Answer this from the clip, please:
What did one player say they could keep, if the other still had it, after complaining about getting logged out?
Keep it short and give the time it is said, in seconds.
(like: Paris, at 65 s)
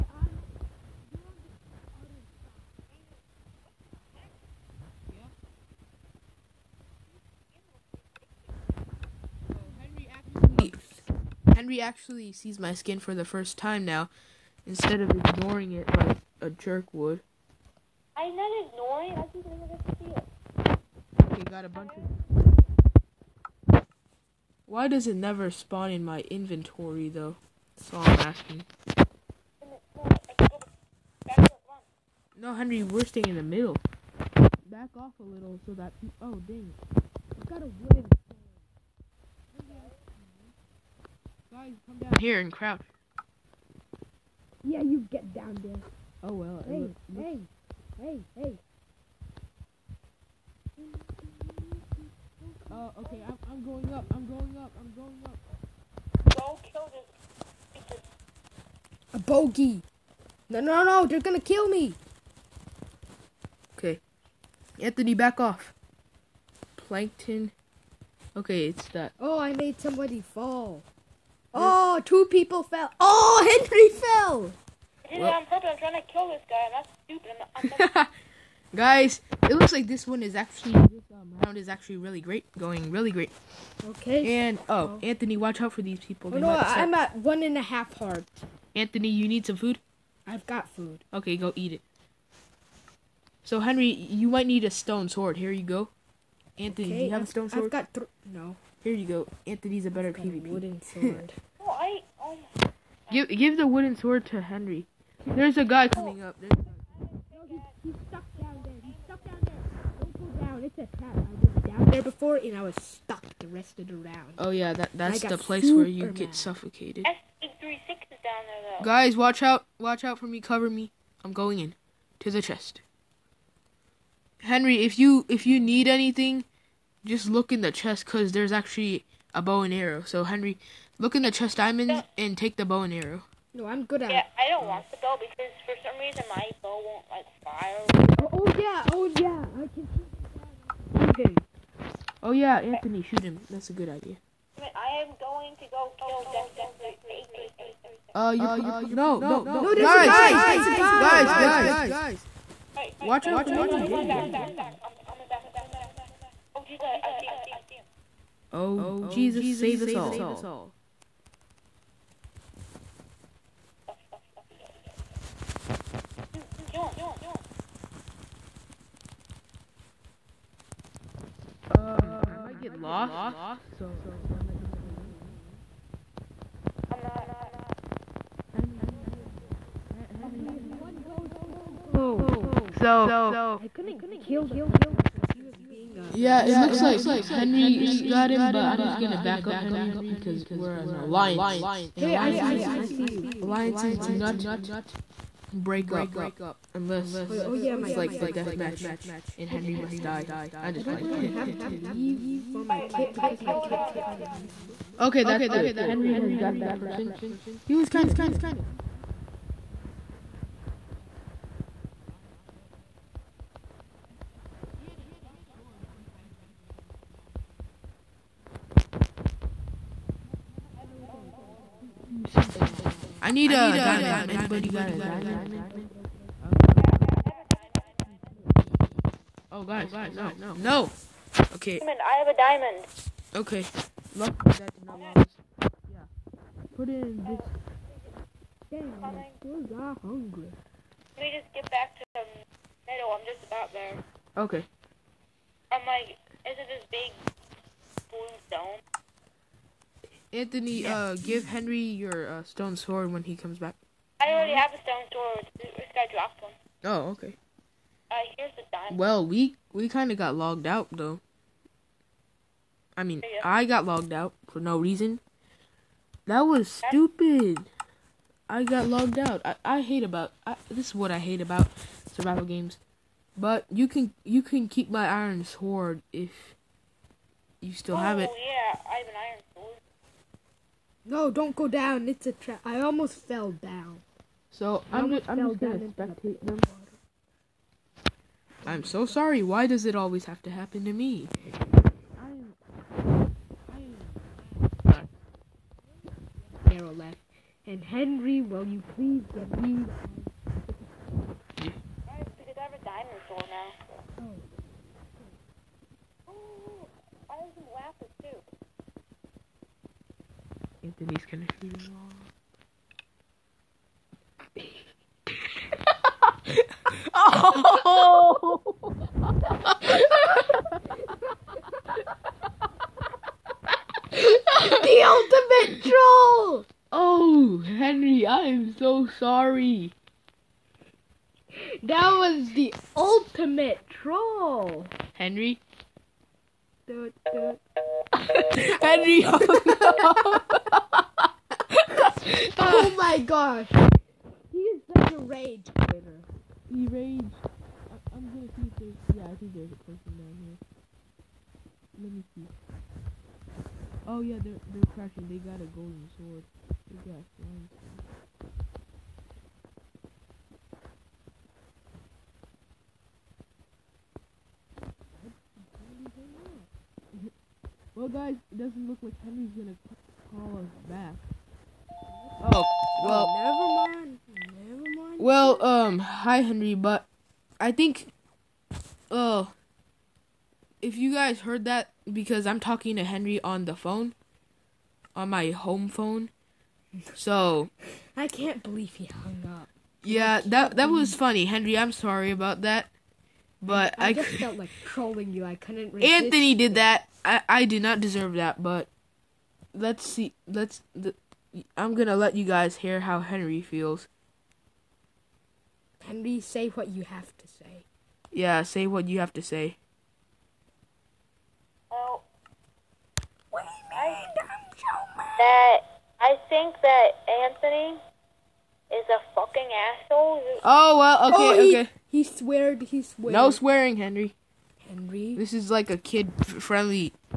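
iron sword, at 275 s.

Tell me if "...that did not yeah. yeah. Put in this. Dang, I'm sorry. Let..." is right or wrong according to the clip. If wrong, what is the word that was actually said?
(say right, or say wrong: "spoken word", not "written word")
wrong: "hungry", not "sorry".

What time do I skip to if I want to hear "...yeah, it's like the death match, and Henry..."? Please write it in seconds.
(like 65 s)
197 s.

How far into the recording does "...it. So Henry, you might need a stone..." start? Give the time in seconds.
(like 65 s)
91 s.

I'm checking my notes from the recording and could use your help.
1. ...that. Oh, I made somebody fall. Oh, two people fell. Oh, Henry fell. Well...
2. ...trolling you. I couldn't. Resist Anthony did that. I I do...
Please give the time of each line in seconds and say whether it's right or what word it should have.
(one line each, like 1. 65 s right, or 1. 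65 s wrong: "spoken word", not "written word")
1. 68 s right
2. 394 s right.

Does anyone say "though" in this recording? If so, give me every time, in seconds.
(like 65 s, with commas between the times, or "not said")
27 s, 118 s, 260 s.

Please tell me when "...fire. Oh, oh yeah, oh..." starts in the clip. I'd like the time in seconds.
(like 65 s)
137 s.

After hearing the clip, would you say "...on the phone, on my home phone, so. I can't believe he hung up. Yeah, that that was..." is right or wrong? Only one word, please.
right.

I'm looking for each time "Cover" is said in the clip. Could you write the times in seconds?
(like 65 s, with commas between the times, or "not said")
120 s.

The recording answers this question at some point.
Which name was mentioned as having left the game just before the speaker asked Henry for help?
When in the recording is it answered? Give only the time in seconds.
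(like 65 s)
296 s.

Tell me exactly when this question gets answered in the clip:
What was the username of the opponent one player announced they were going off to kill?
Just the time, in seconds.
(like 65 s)
146 s.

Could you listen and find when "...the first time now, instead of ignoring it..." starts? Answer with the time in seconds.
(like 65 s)
13 s.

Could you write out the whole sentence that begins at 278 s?
yeah, I have an iron no, don't go down.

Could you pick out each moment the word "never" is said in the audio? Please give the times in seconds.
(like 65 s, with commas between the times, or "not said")
19 s, 25 s.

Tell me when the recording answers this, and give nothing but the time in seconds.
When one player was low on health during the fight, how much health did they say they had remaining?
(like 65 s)
87 s.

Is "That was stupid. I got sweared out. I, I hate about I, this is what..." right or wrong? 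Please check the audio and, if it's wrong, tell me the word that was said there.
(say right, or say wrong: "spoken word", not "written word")
wrong: "logged", not "sweared".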